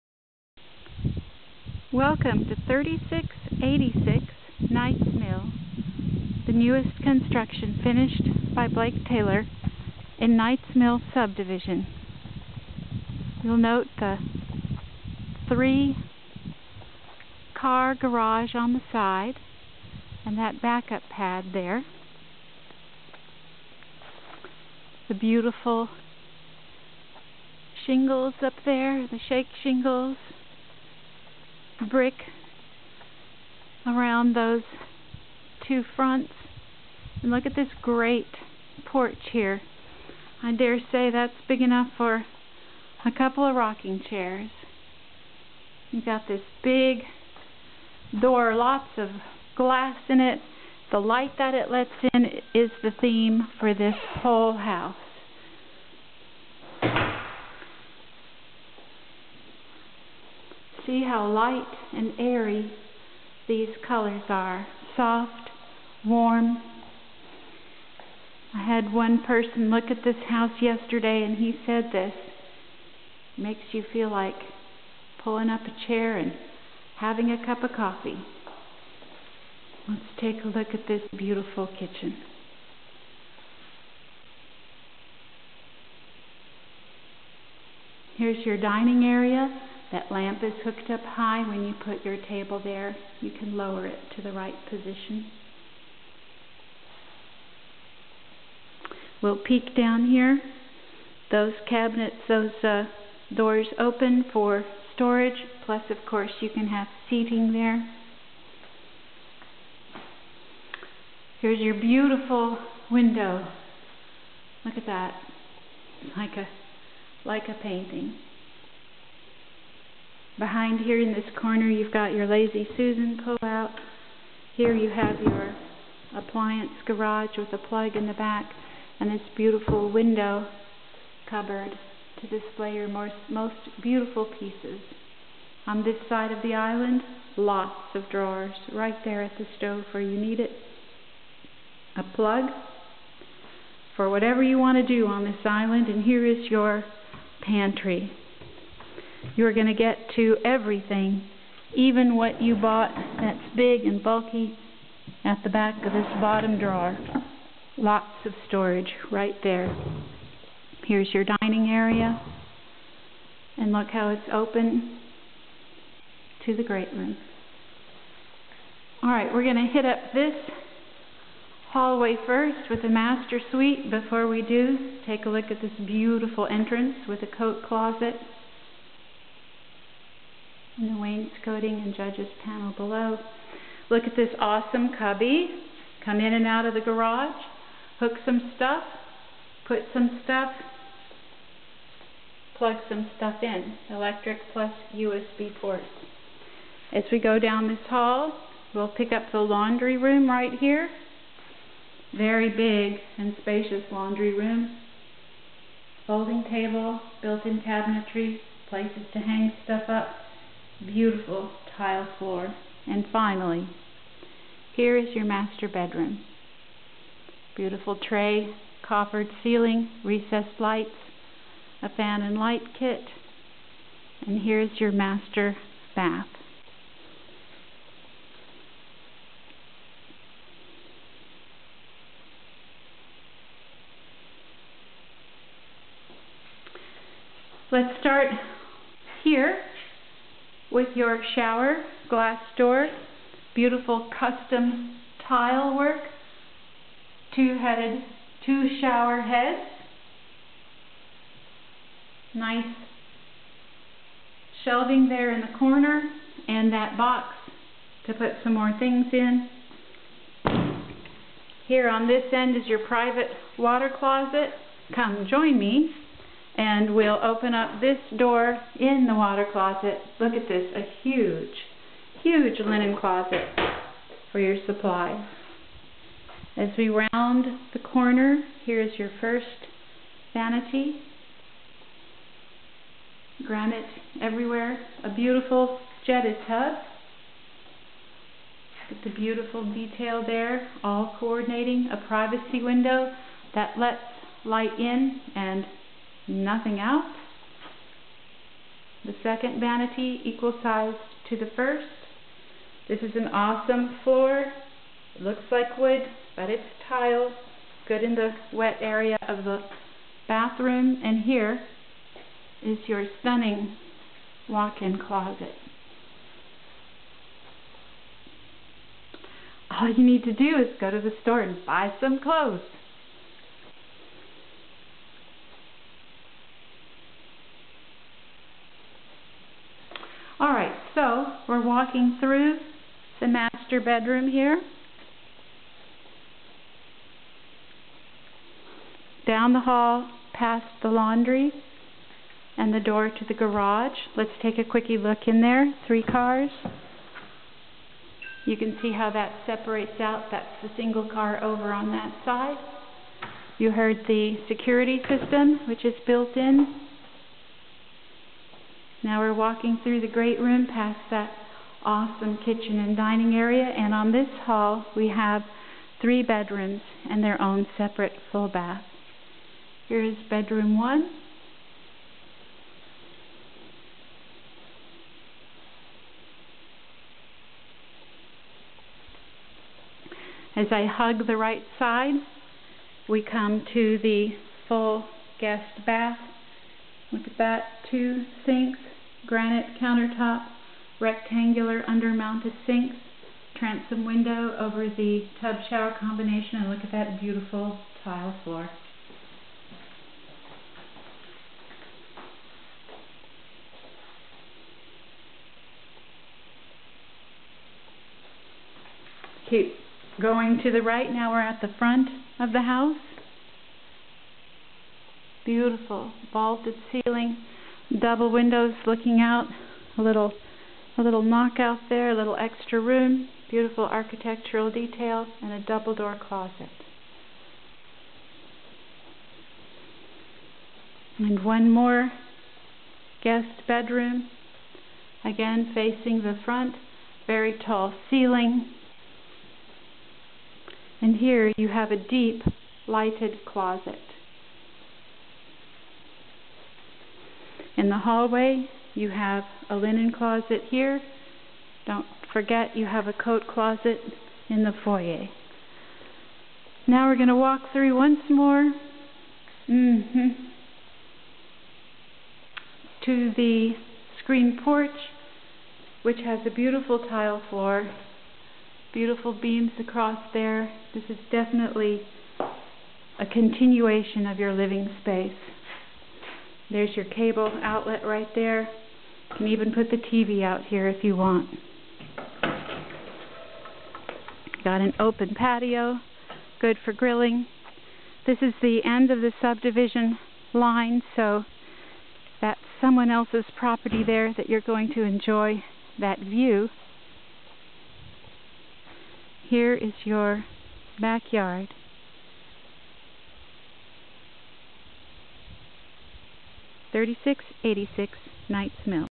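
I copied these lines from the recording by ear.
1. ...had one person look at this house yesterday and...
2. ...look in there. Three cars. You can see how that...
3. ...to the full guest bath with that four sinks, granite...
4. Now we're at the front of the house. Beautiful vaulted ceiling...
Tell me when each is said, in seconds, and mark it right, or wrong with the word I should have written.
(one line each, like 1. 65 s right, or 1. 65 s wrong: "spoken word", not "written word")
1. 68 s right
2. 344 s right
3. 383 s wrong: "two", not "four"
4. 411 s right.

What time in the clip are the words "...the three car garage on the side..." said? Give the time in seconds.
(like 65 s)
13 s.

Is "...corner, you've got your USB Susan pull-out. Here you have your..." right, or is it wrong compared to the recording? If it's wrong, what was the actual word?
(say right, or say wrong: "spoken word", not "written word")
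wrong: "Lazy", not "USB".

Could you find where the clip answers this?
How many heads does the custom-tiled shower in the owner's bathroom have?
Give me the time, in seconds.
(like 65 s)
248 s.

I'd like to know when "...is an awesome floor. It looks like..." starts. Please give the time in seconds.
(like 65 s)
303 s.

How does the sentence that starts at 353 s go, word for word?
You heard the security system, which is built in.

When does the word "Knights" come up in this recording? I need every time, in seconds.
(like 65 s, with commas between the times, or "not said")
4 s, 10 s, 508 s.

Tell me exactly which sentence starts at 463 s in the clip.
to the screen porch, which has a beautiful tile floor, beautiful beams across there.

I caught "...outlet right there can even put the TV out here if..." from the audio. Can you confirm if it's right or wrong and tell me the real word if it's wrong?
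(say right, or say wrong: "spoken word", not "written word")
right.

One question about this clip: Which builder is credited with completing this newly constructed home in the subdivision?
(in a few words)
Blake Taylor.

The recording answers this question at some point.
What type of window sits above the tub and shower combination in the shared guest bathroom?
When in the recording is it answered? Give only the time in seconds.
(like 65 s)
393 s.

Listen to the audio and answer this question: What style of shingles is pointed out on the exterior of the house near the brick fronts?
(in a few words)
Shake shingles.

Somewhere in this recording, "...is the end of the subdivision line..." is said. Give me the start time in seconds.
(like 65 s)
488 s.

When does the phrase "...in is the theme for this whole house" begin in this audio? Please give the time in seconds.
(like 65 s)
52 s.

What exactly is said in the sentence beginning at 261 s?
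Here on this end is your private water closet.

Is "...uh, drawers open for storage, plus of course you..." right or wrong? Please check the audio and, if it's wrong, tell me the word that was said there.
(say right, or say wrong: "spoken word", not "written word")
wrong: "doors", not "drawers".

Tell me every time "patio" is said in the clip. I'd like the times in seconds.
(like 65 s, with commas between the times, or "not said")
485 s.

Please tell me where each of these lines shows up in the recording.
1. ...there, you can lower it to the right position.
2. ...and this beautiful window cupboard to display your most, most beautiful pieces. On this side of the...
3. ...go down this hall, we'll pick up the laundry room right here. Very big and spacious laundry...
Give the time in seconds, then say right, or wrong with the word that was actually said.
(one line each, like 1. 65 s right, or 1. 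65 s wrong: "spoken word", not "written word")
1. 92 s right
2. 128 s right
3. 197 s right.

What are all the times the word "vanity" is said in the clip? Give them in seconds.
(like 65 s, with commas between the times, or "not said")
280 s, 299 s.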